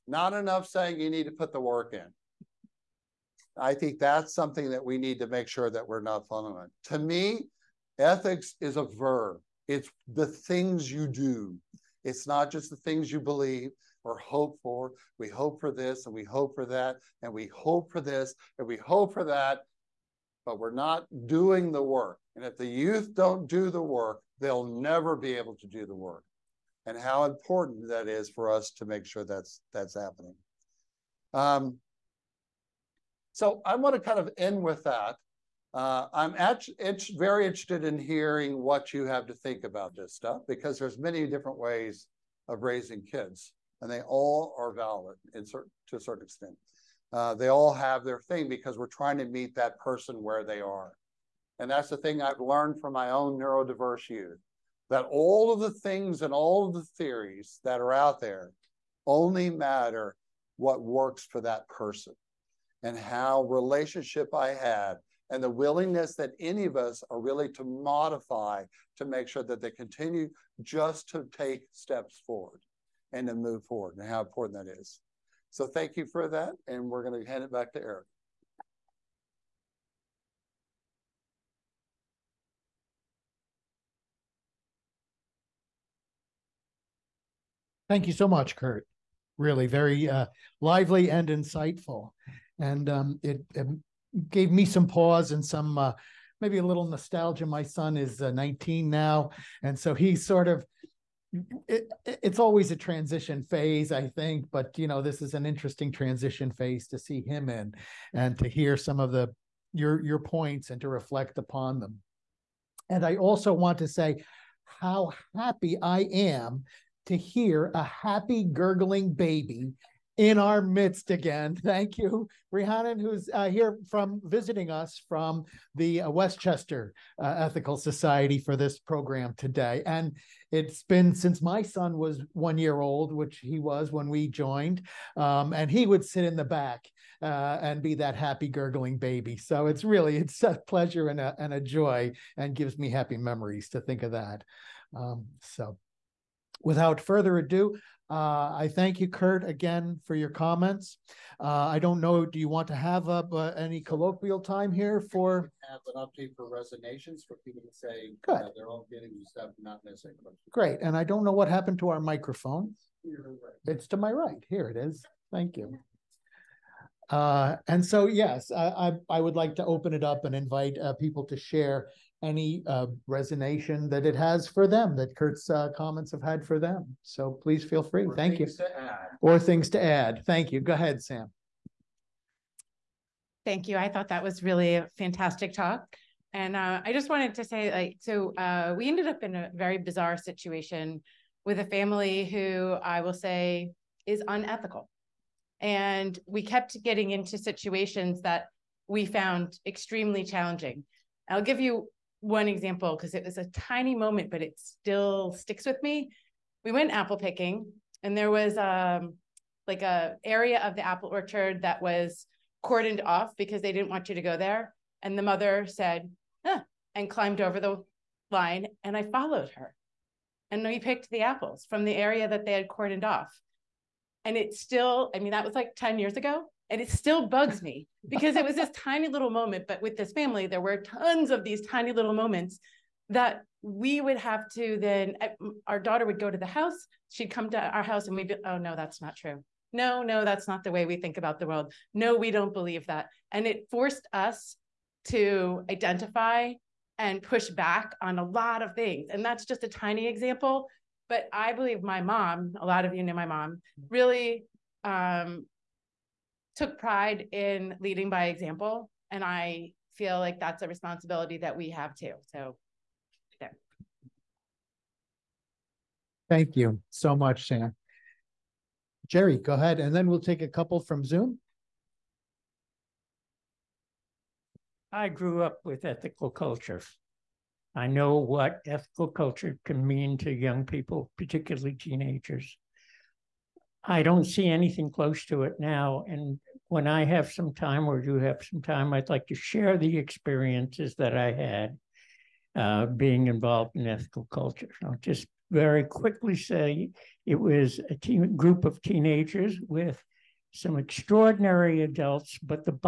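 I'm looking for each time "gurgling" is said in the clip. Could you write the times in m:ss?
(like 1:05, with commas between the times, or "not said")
1:58, 2:18.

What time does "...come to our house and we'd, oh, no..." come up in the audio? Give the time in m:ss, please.
3:57.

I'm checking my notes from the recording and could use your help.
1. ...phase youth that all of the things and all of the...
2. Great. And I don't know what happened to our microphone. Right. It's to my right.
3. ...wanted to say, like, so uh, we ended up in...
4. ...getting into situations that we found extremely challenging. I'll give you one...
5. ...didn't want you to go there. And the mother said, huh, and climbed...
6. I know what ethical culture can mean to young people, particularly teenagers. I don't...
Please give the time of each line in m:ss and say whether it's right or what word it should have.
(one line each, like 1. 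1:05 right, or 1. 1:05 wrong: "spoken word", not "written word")
1. 0:53 wrong: "neurodiverse", not "phase"
2. 2:40 right
3. 3:07 right
4. 3:16 right
5. 3:33 right
6. 4:37 right.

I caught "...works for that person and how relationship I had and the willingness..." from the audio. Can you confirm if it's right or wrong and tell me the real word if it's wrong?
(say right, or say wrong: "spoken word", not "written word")
right.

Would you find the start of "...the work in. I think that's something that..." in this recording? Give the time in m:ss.
0:01.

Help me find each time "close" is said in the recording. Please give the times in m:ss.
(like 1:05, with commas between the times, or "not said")
4:44.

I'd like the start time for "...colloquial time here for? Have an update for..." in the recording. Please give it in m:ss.
2:33.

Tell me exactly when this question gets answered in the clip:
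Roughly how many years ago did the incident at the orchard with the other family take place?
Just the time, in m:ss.
3:45.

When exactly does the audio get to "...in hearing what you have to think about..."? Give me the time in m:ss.
0:37.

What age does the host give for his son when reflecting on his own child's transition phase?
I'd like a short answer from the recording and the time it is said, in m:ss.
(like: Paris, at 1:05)
19, at 1:38.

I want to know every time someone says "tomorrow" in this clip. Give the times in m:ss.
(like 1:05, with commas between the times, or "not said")
not said.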